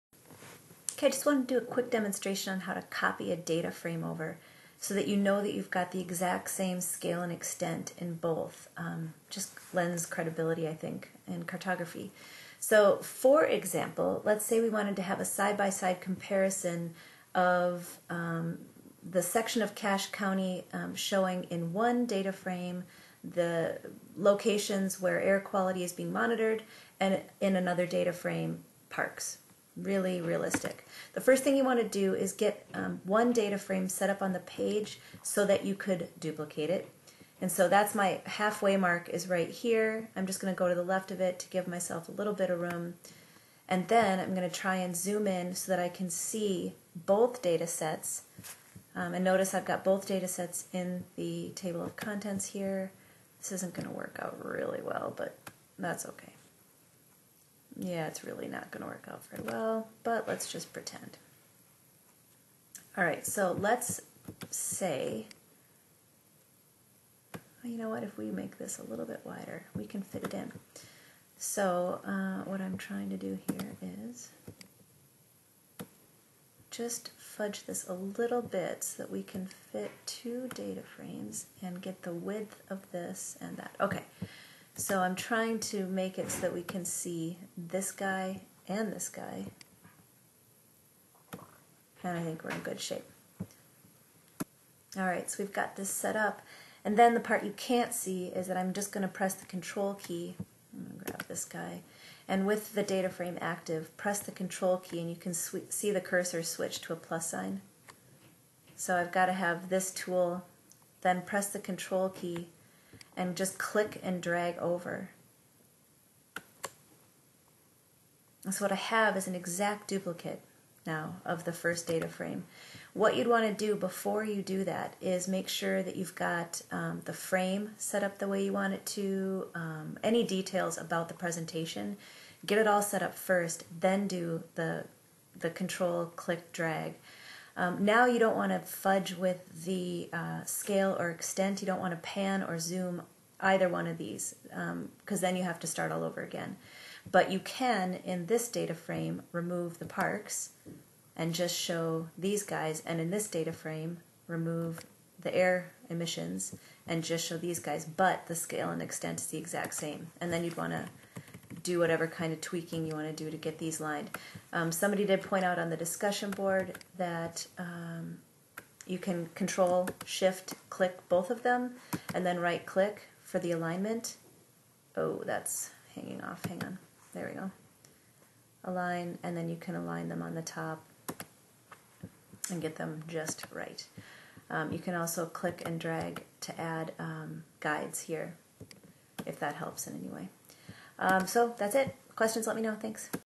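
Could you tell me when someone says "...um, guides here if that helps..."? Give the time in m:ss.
3:06.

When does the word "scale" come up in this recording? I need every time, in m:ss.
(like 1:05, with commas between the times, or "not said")
0:06, 2:20, 2:38.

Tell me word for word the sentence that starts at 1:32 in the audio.
And I think we're in good shape.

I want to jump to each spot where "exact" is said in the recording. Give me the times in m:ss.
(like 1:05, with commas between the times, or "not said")
0:05, 1:59, 2:39.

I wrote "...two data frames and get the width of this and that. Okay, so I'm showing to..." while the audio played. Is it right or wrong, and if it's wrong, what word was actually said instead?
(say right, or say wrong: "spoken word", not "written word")
wrong: "trying", not "showing".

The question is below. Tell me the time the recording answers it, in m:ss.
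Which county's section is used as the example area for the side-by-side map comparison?
0:19.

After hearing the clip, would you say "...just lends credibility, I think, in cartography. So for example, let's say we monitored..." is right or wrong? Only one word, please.
wrong.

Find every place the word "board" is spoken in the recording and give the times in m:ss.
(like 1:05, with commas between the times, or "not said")
2:46.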